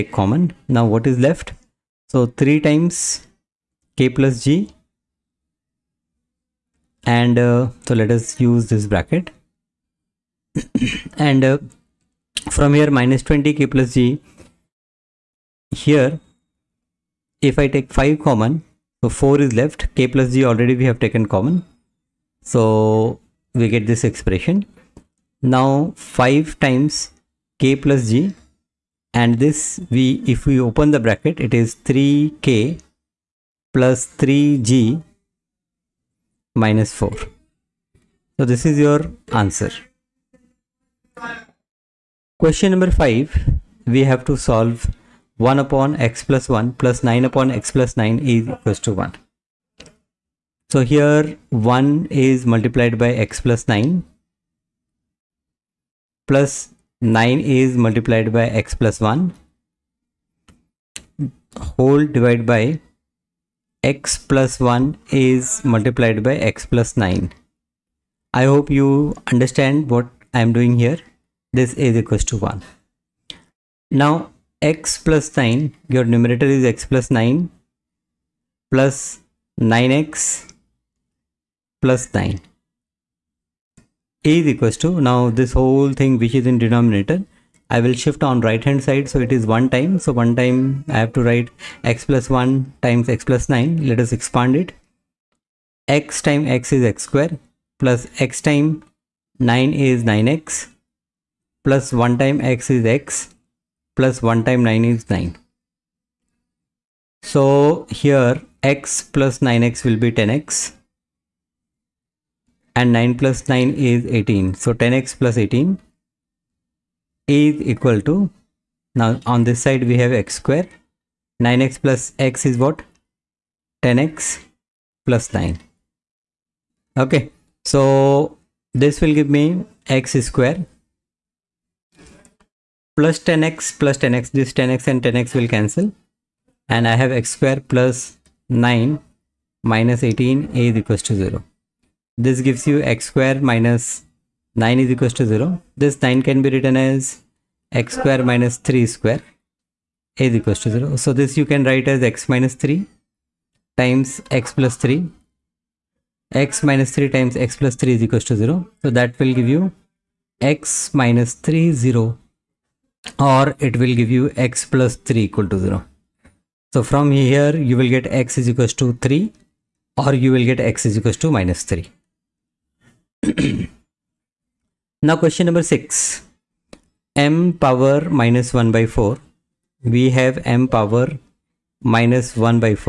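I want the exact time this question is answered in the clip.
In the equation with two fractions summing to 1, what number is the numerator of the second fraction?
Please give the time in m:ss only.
0:46.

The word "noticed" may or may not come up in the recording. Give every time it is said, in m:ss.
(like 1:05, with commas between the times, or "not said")
not said.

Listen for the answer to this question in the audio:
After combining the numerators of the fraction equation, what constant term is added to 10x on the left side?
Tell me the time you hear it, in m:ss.
1:54.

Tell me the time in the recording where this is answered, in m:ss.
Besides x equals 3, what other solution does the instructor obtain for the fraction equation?
2:50.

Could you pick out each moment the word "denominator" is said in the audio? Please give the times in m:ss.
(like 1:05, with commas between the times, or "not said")
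1:26.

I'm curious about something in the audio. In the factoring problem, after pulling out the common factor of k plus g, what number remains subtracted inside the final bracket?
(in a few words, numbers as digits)
4.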